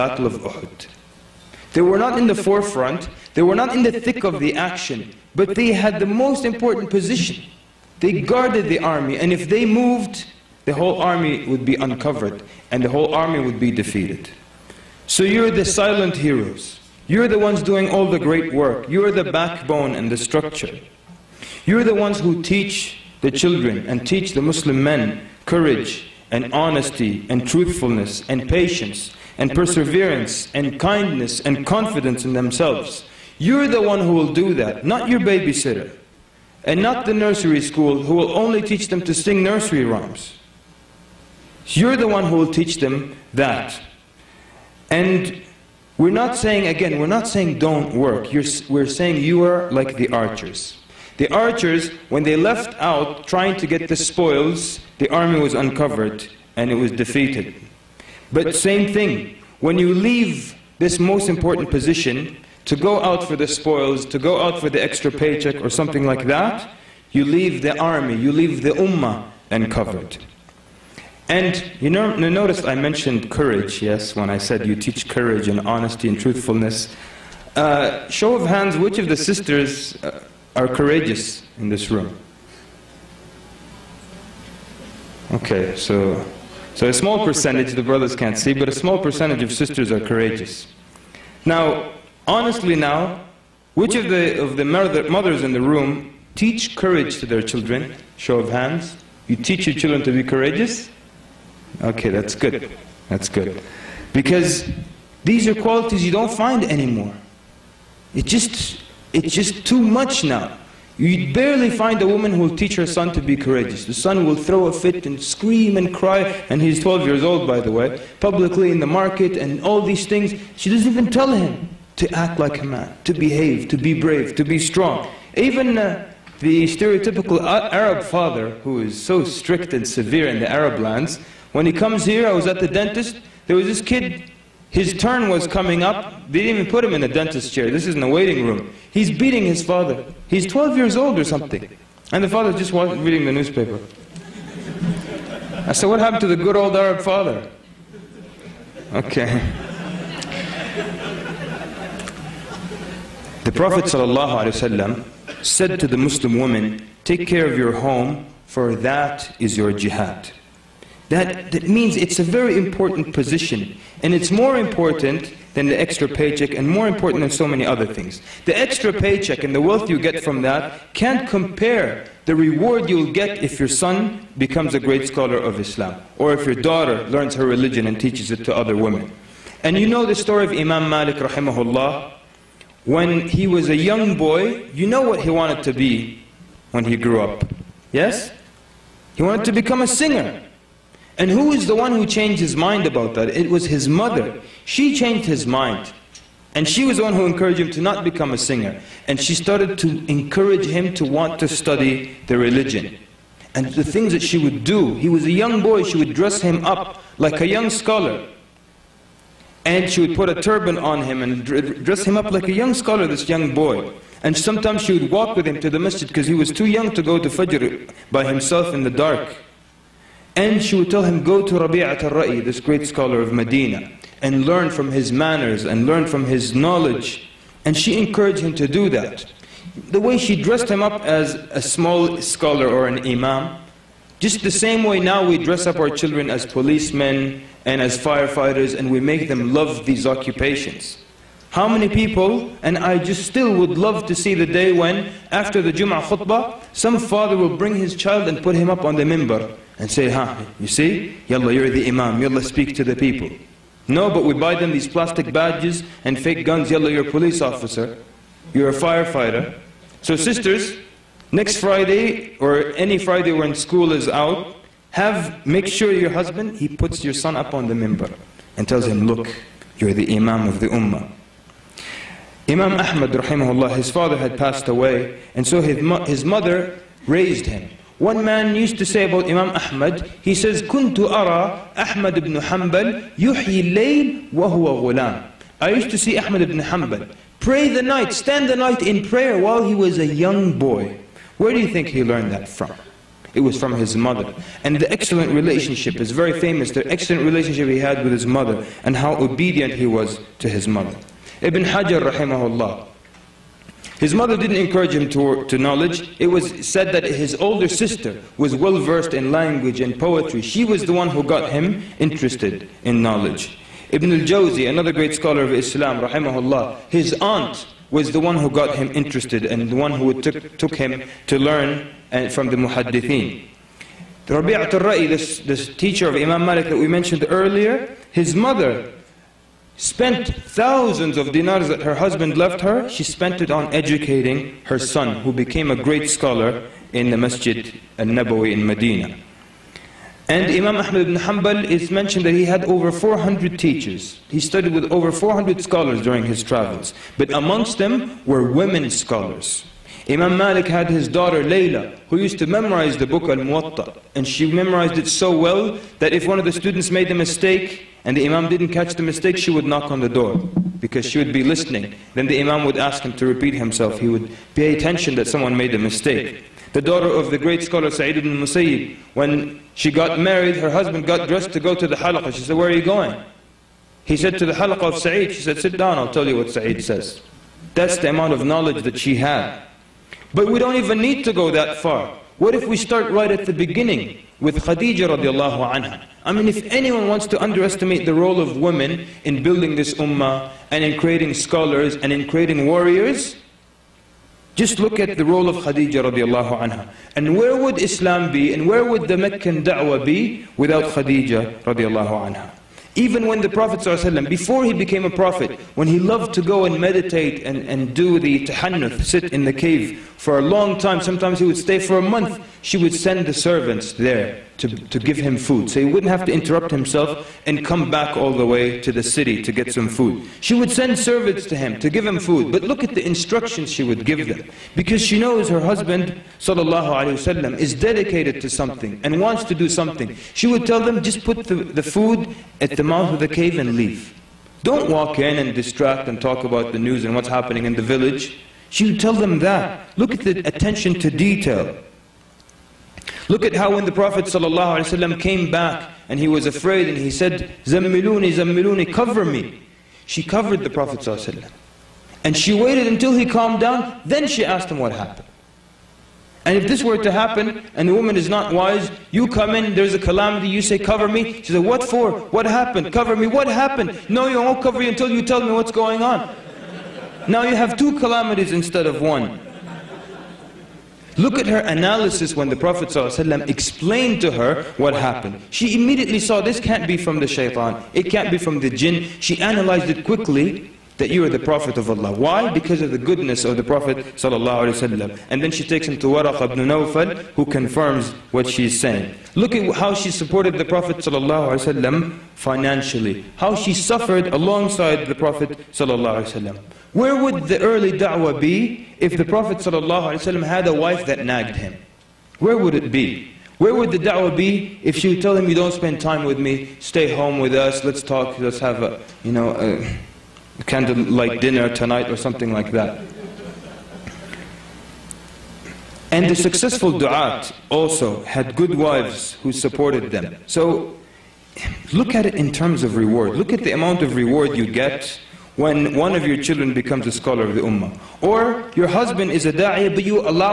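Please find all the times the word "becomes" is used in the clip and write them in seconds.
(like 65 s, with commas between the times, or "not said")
174 s, 189 s, 198 s, 526 s.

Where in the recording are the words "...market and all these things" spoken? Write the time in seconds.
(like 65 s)
118 s.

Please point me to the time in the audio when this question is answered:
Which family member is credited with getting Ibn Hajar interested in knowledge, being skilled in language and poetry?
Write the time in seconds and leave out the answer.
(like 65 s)
307 s.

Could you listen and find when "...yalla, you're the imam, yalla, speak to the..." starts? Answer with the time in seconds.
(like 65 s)
251 s.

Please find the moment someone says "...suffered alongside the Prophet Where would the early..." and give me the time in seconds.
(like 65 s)
493 s.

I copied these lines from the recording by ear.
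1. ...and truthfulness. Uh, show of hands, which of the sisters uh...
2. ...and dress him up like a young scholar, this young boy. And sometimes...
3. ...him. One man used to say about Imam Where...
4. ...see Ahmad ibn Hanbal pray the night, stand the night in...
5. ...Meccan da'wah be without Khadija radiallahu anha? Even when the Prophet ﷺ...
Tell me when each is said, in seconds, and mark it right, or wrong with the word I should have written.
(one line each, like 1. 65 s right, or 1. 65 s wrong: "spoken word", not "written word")
1. 76 s right
2. 211 s right
3. 277 s wrong: "Ahmad", not "Where"
4. 285 s right
5. 399 s right.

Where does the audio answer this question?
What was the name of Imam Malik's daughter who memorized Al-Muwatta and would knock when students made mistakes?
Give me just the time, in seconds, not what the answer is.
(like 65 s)
351 s.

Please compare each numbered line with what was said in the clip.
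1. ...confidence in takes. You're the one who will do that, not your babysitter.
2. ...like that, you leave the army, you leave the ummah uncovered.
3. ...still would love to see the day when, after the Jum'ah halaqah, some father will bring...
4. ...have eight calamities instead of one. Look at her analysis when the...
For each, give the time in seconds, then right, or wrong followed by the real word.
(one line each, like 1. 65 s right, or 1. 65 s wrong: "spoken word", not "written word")
1. 31 s wrong: "themselves", not "takes"
2. 66 s right
3. 243 s wrong: "khutbah", not "halaqah"
4. 467 s wrong: "two", not "eight".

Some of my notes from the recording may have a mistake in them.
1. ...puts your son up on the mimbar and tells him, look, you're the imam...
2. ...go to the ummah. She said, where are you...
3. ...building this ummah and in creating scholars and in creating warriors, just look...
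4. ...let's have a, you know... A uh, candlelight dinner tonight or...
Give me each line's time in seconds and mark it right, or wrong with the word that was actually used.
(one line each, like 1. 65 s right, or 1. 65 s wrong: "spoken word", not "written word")
1. 266 s right
2. 371 s wrong: "halaqah", not "ummah"
3. 389 s right
4. 508 s right.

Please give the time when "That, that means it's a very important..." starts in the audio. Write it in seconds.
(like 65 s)
161 s.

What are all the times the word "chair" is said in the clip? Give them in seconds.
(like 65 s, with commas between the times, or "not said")
137 s.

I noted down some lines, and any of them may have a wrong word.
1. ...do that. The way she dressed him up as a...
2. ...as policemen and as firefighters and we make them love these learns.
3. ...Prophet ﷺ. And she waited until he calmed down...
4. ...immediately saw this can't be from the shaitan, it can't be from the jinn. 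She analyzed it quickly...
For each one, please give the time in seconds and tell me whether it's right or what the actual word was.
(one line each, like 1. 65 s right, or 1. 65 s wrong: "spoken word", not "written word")
1. 228 s right
2. 236 s wrong: "occupations", not "learns"
3. 450 s right
4. 475 s right.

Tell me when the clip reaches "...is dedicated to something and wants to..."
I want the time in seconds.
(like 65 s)
427 s.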